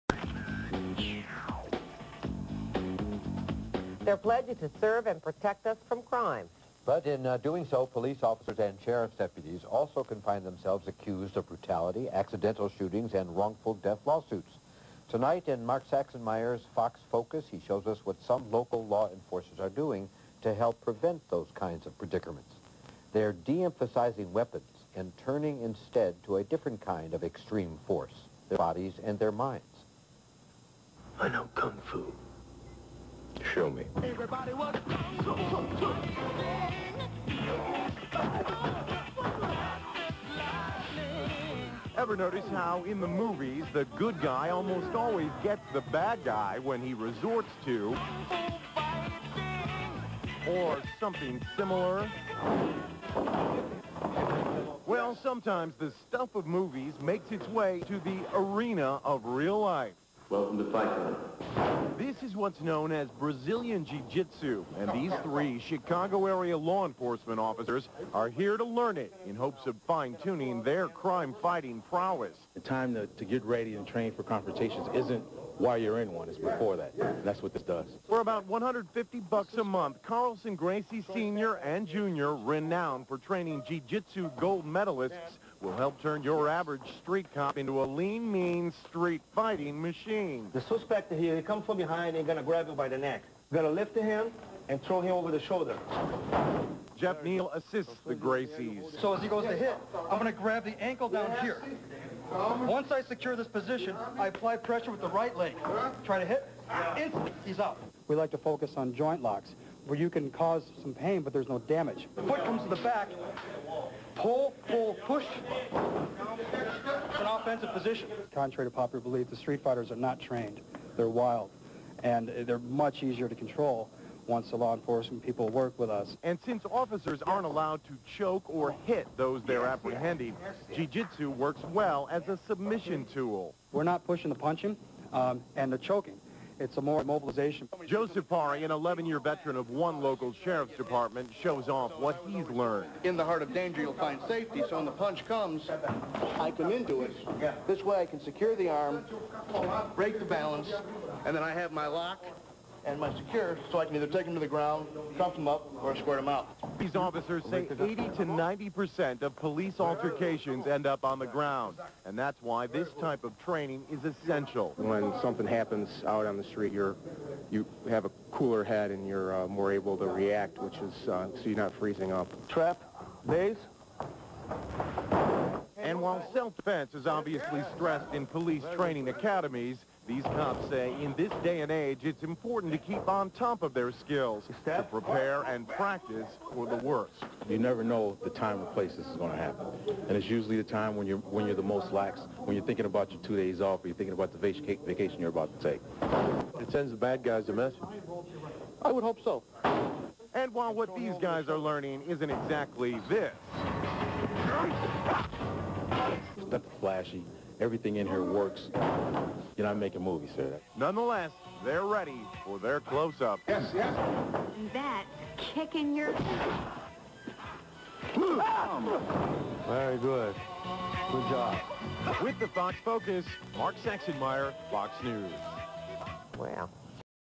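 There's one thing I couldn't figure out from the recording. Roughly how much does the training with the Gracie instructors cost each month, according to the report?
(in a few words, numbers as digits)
$150.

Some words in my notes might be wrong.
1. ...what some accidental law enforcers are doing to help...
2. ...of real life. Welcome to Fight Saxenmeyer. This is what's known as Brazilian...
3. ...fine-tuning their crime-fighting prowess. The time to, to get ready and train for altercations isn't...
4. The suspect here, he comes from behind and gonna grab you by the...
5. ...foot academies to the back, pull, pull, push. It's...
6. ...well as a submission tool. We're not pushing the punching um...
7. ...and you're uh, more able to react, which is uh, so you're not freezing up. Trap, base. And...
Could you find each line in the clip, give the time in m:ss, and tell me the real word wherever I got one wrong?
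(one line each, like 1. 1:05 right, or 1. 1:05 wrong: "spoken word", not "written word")
1. 0:18 wrong: "local", not "accidental"
2. 0:59 wrong: "Club", not "Saxenmeyer"
3. 1:09 wrong: "confrontations", not "altercations"
4. 1:30 right
5. 1:52 wrong: "comes", not "academies"
6. 2:11 right
7. 2:48 right.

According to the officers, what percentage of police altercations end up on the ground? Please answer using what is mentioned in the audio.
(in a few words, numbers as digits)
80 to 90%.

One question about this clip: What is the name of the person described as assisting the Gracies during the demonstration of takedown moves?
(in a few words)
Jeff Neal.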